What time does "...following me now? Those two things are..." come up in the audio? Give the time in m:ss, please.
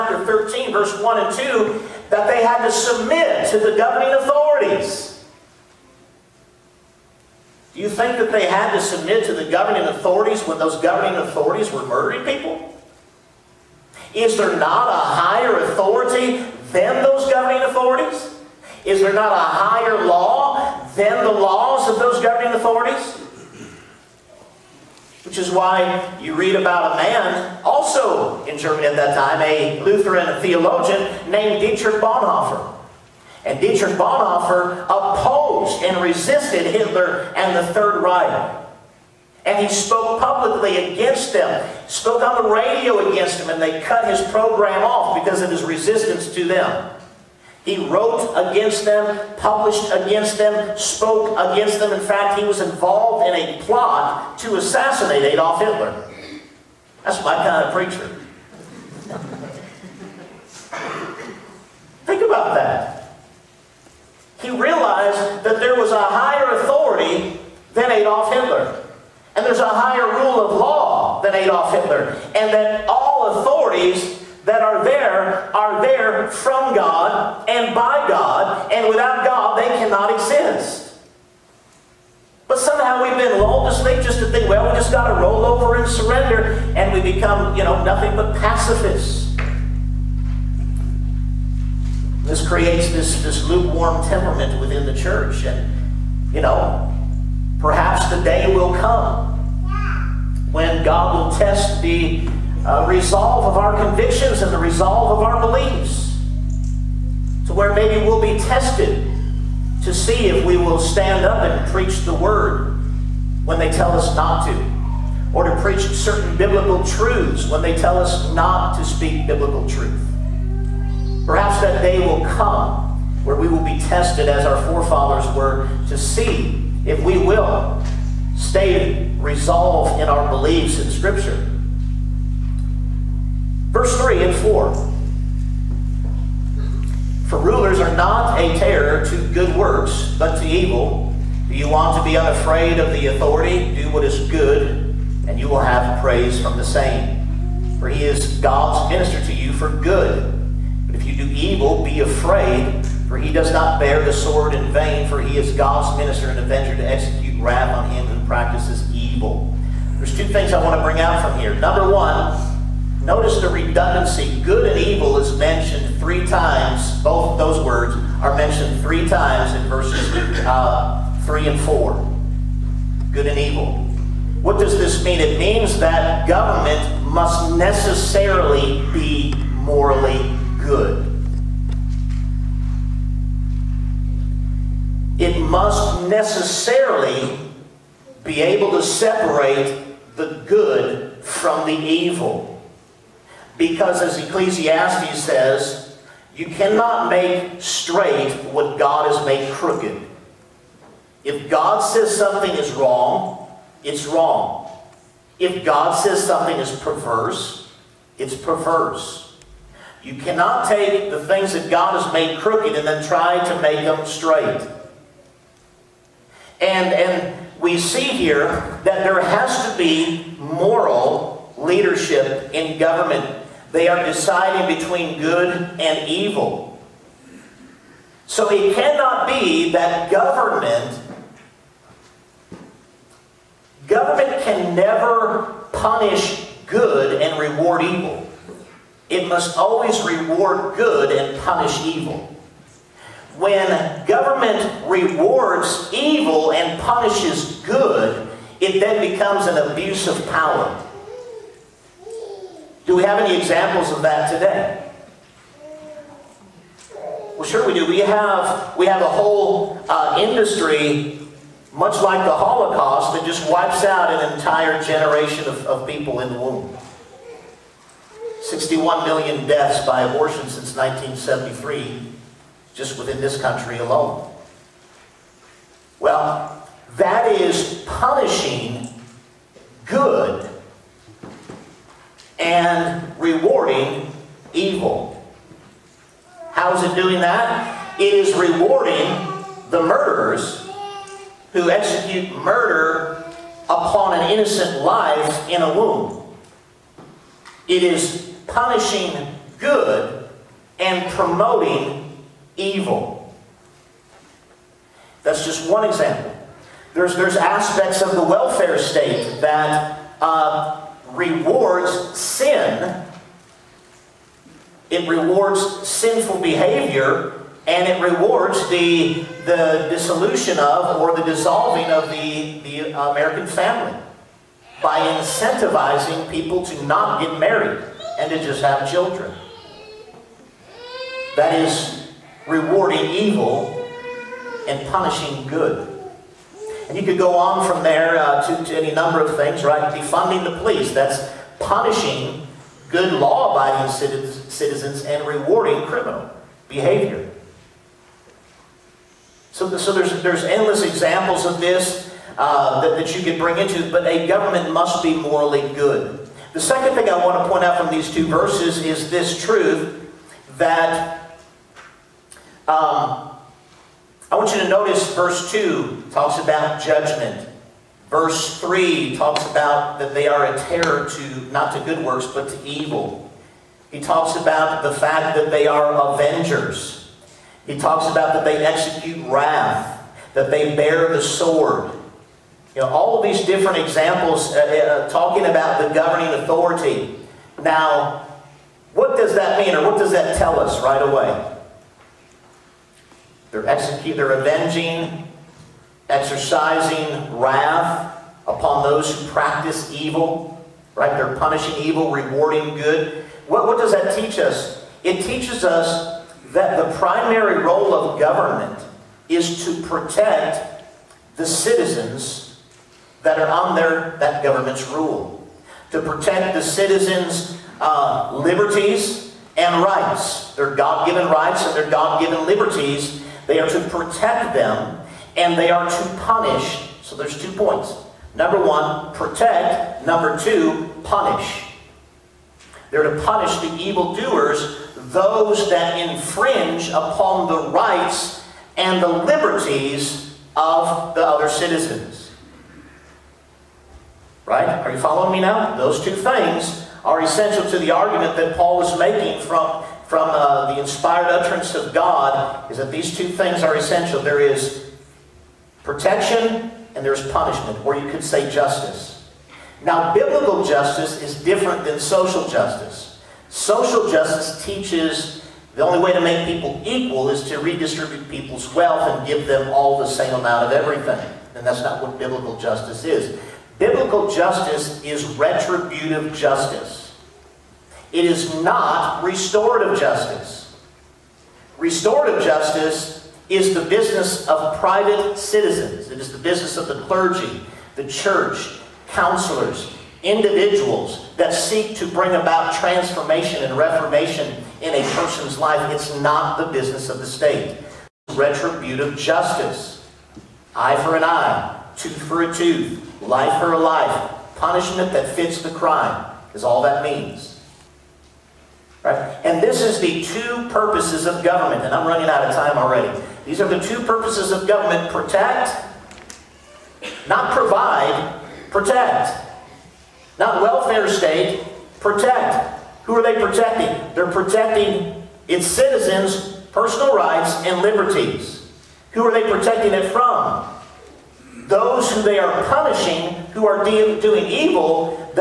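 7:24.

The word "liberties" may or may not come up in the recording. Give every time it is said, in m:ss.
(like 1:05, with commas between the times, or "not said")
6:58, 7:02, 7:19, 8:47.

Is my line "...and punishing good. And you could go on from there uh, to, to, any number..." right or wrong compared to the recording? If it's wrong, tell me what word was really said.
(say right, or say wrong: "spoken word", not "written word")
right.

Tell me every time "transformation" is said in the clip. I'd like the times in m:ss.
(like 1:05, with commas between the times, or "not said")
8:12.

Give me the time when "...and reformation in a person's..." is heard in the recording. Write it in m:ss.
8:13.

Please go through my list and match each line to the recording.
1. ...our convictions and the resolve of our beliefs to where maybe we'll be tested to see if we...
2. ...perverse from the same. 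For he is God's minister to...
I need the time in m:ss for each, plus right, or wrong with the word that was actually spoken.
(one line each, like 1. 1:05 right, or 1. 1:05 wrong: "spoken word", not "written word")
1. 1:43 right
2. 2:25 wrong: "praise", not "perverse".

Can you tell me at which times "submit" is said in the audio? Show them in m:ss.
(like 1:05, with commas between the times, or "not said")
0:02, 0:08.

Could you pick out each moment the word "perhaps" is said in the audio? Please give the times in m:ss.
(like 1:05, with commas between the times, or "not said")
1:37, 2:01.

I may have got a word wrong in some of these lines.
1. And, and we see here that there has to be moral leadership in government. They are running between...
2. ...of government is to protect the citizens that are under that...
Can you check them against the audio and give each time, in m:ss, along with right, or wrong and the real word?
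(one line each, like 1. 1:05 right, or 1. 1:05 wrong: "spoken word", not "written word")
1. 3:36 wrong: "deciding", not "running"
2. 6:47 right.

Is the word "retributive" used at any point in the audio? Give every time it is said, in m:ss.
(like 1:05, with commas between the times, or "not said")
7:55, 8:18.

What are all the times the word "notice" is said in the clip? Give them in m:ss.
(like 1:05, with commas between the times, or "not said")
2:43, 6:04.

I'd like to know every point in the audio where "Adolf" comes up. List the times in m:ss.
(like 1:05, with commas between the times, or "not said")
0:55.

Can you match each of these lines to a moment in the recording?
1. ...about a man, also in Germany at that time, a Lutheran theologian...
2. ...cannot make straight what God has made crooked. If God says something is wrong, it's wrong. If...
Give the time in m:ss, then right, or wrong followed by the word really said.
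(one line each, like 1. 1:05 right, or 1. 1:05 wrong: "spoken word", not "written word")
1. 0:26 right
2. 3:16 right.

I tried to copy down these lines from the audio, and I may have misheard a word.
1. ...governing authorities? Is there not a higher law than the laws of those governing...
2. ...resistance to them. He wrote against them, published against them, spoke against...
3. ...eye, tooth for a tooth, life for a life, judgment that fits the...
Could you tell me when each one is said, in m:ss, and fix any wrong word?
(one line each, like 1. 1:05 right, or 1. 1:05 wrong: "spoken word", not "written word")
1. 0:17 right
2. 0:45 right
3. 8:21 wrong: "punishment", not "judgment".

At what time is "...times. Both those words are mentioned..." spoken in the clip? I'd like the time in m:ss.
2:46.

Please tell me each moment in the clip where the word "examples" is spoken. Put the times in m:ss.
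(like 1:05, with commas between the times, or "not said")
4:13, 5:05, 5:50, 6:23.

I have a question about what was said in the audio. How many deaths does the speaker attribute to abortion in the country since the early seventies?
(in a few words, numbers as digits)
61 million.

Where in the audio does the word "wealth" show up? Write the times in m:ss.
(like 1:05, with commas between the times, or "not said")
7:48.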